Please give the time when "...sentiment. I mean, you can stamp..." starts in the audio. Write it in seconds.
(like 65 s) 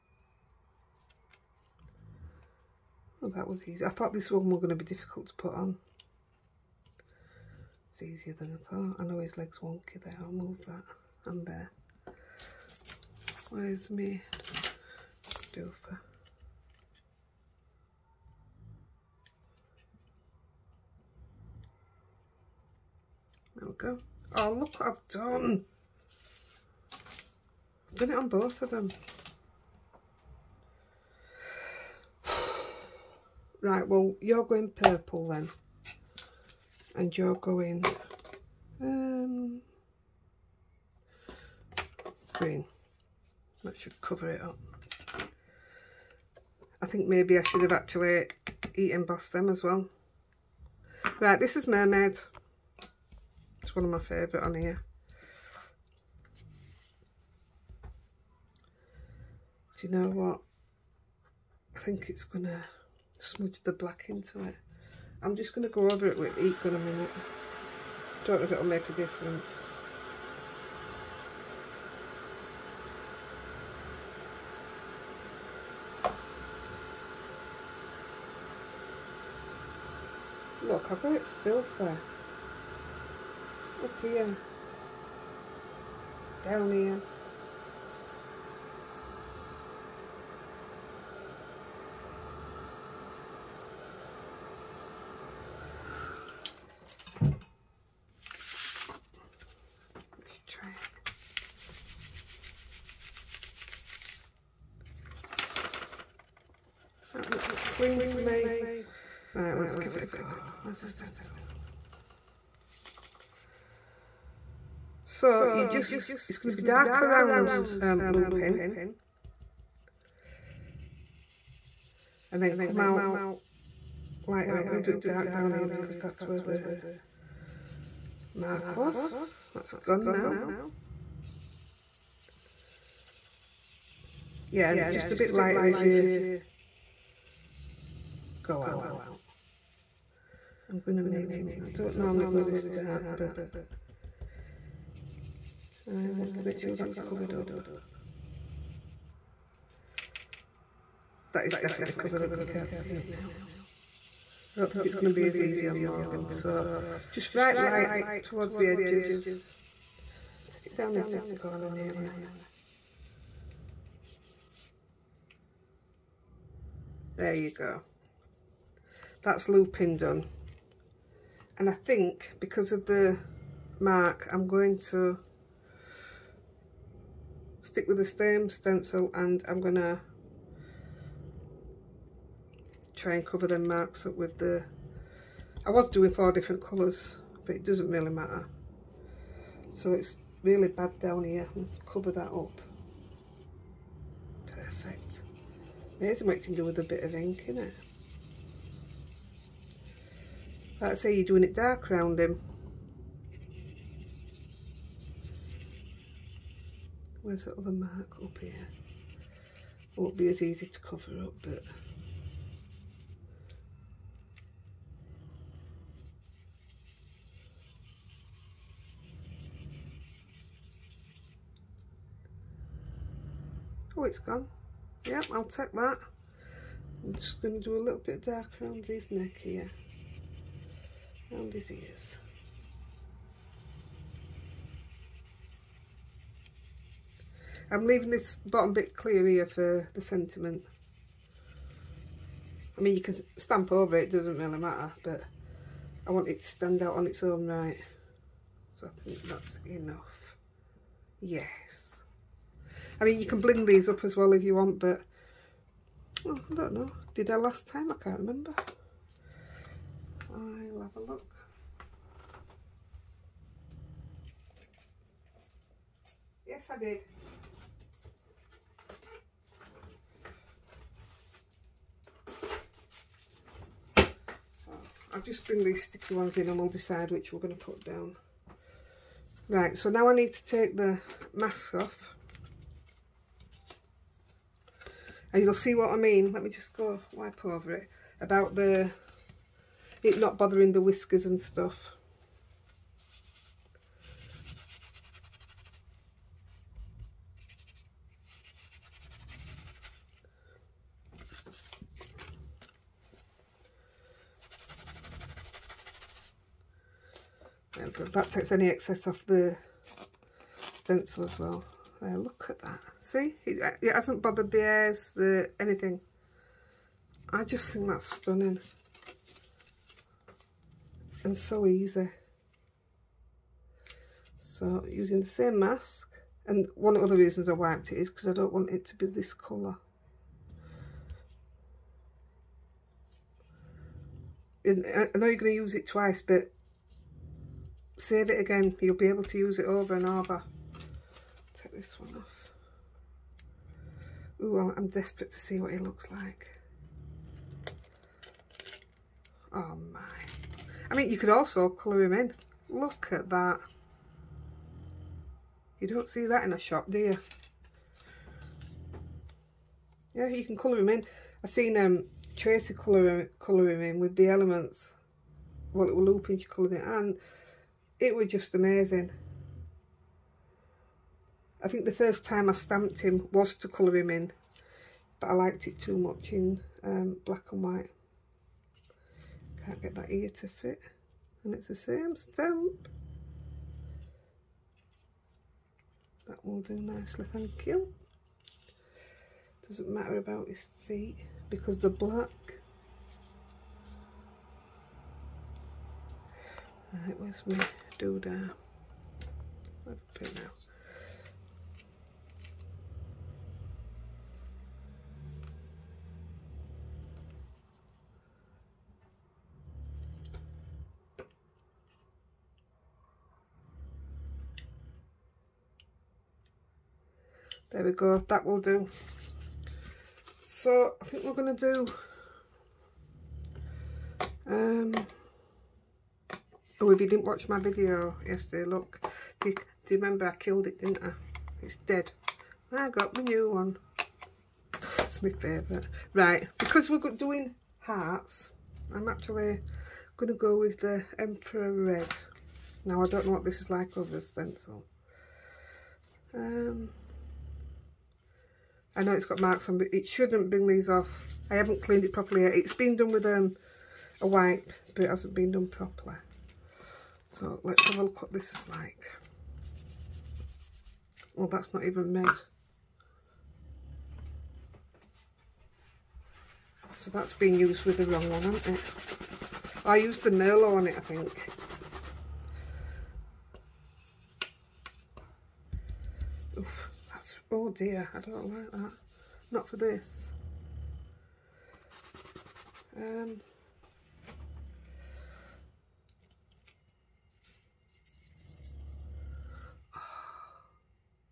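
240 s.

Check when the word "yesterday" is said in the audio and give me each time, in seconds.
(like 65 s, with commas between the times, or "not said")
428 s.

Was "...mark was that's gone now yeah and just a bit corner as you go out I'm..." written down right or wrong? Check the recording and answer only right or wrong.
wrong.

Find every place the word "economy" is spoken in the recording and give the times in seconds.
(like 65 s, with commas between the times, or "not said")
not said.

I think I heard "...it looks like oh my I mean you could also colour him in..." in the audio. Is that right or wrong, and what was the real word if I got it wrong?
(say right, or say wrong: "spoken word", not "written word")
right.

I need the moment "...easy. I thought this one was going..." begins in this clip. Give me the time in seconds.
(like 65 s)
3 s.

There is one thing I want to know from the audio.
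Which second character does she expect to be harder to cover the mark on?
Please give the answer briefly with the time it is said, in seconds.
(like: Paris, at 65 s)
Morgan, at 155 s.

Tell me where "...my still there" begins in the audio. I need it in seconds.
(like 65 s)
397 s.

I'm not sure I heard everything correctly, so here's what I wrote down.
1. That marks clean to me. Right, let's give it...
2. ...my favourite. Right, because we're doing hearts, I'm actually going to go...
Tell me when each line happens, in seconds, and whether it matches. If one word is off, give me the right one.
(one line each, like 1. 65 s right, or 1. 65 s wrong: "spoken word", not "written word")
1. 107 s wrong: "looks", not "marks"
2. 435 s right.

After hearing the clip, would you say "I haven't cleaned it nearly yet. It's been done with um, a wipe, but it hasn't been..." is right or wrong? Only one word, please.
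wrong.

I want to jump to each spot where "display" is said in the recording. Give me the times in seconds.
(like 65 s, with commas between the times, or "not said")
not said.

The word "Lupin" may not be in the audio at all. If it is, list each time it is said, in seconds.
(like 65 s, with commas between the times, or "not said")
118 s, 169 s.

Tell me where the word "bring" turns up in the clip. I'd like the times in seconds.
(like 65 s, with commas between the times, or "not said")
275 s, 450 s.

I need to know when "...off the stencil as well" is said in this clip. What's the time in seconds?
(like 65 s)
309 s.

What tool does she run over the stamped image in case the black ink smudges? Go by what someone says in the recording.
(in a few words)
Heat gun.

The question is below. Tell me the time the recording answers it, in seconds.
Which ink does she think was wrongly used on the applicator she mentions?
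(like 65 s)
470 s.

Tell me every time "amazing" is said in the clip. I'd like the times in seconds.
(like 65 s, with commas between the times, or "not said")
196 s, 368 s.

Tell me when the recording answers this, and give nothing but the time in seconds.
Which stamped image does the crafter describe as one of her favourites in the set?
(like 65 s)
51 s.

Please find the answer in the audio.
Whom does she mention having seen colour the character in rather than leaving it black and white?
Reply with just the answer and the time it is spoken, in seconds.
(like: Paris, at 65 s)
Tracy, at 362 s.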